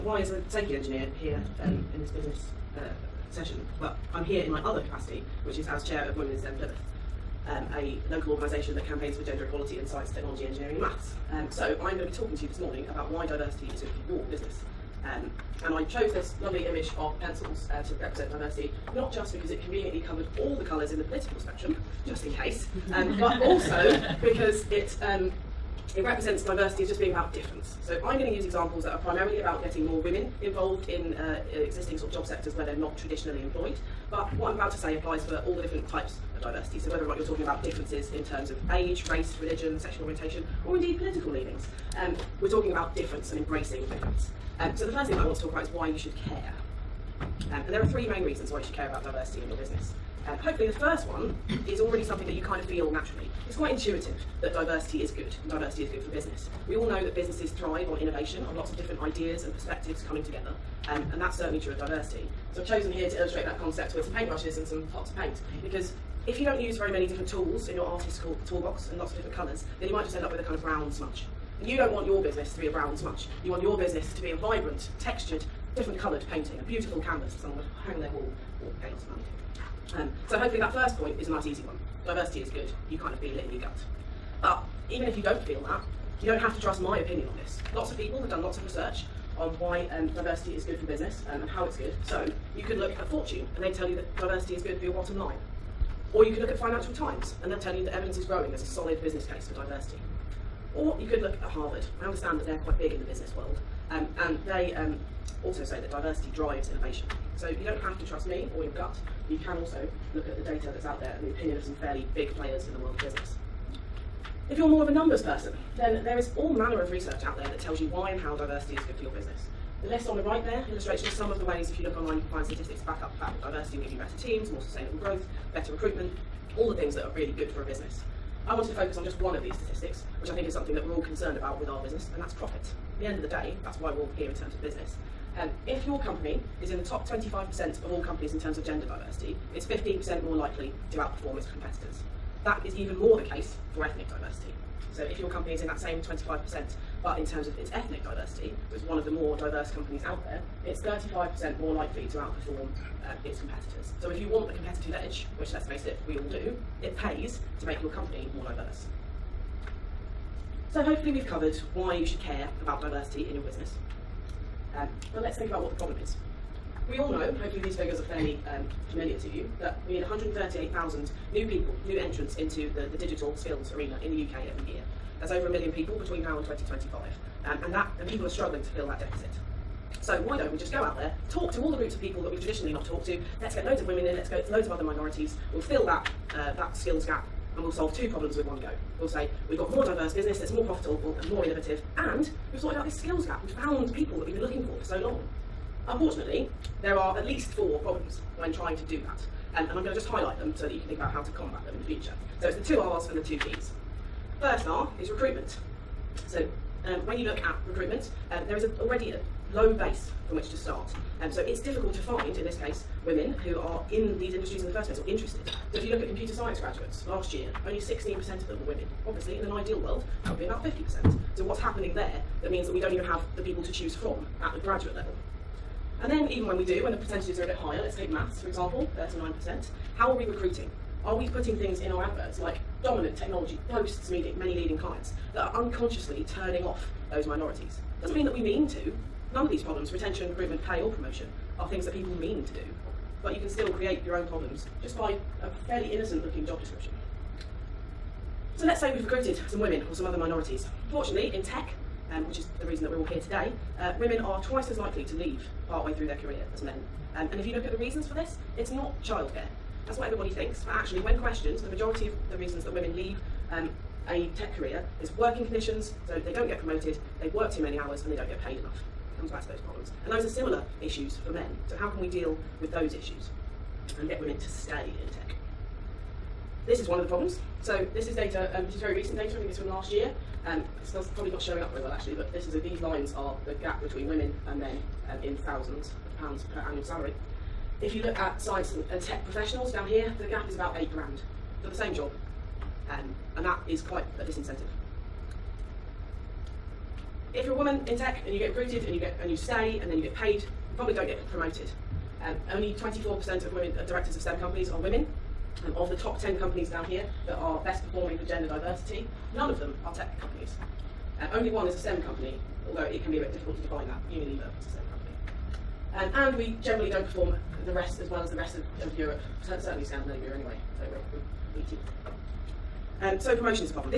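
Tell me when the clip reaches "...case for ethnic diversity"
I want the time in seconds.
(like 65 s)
143 s.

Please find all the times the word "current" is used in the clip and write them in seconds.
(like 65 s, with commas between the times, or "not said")
not said.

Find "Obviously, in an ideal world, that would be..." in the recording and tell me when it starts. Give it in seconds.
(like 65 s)
219 s.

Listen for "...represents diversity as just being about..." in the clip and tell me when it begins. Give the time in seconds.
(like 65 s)
26 s.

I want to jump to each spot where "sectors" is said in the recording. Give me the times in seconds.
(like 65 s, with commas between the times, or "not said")
32 s.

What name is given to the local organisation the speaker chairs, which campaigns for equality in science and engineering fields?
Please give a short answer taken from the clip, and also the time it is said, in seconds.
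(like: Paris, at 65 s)
Women in STEM Plymouth, at 6 s.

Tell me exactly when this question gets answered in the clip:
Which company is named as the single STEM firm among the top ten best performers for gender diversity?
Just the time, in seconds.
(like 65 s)
314 s.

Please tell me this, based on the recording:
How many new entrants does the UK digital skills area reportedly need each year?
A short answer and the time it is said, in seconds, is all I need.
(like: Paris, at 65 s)
138,000, at 170 s.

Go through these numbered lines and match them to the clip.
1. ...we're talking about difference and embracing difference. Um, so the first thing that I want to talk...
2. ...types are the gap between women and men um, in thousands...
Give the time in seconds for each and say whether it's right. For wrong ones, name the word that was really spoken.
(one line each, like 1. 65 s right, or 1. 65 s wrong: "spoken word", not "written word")
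1. 42 s right
2. 282 s wrong: "lines", not "types".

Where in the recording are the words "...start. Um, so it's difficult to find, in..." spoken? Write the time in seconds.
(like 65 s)
210 s.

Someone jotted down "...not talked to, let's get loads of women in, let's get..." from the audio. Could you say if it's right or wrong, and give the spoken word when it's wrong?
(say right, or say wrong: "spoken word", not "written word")
right.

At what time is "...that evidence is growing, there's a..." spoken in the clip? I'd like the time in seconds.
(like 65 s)
97 s.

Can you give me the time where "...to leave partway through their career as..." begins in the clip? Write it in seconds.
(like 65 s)
255 s.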